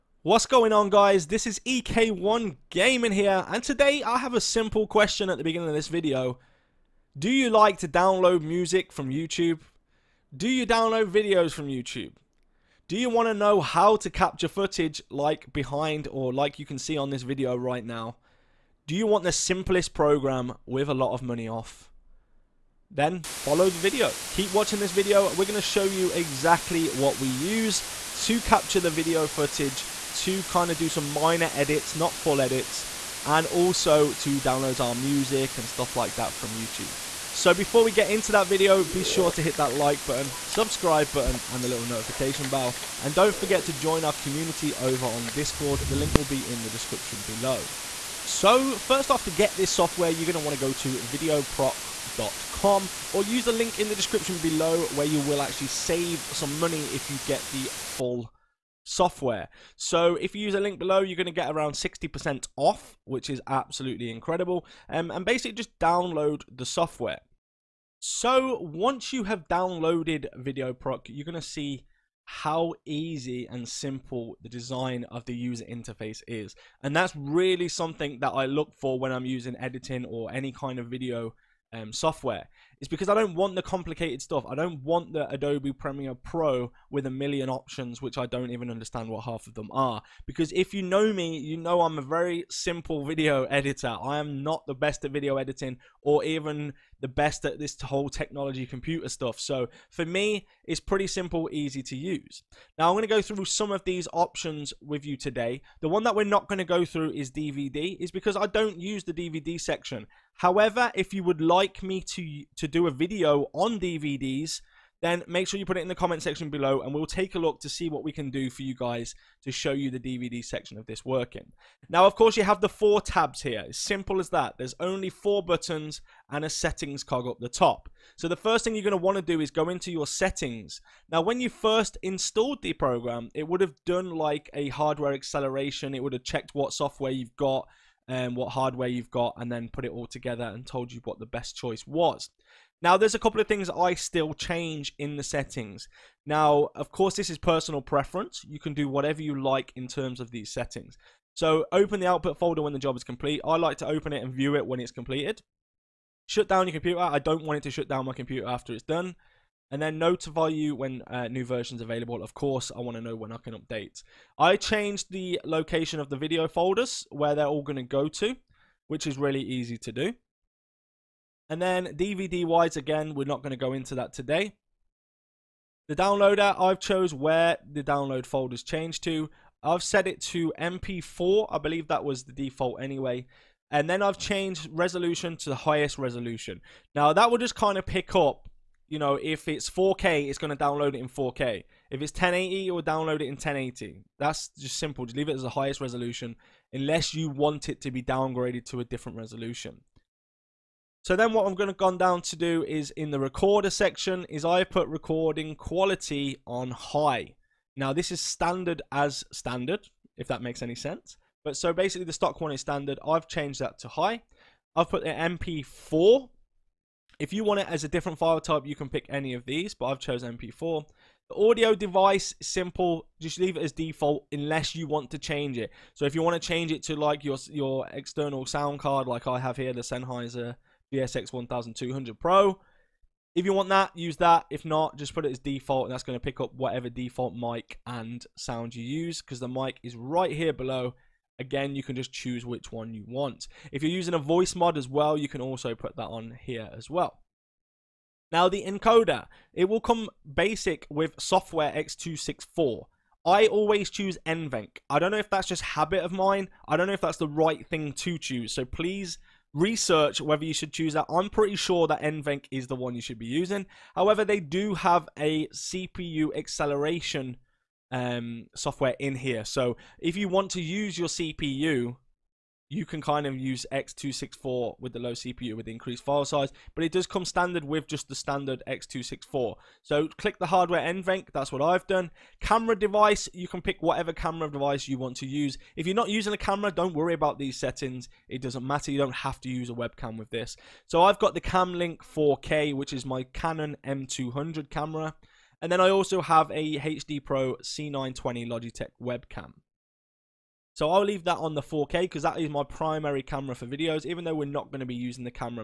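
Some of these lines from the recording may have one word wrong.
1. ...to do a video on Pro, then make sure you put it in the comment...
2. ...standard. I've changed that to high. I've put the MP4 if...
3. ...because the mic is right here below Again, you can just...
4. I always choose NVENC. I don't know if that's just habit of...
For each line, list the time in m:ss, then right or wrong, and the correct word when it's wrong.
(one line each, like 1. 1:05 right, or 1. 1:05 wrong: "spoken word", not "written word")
1. 1:52 wrong: "DVDs", not "Pro"
2. 3:32 right
3. 3:59 right
4. 4:13 right.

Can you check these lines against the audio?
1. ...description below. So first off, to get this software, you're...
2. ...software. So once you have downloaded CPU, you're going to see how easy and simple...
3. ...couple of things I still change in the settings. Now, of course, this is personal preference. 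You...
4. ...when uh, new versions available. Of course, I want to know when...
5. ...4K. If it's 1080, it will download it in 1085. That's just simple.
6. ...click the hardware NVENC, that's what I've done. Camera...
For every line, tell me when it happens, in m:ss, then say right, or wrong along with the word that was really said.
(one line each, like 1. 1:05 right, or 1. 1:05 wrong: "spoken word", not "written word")
1. 0:46 right
2. 1:06 wrong: "VideoProc", not "CPU"
3. 2:23 right
4. 2:40 right
5. 3:11 wrong: "1080", not "1085"
6. 4:40 right.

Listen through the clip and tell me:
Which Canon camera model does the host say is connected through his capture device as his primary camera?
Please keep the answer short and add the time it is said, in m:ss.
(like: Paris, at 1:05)
Canon M200, at 4:53.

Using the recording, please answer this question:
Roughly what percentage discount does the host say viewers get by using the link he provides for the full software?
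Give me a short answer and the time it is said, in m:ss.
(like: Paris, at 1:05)
60%, at 1:01.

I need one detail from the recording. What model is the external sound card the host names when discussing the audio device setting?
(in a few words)
Sennheiser GSX 1200 Pro.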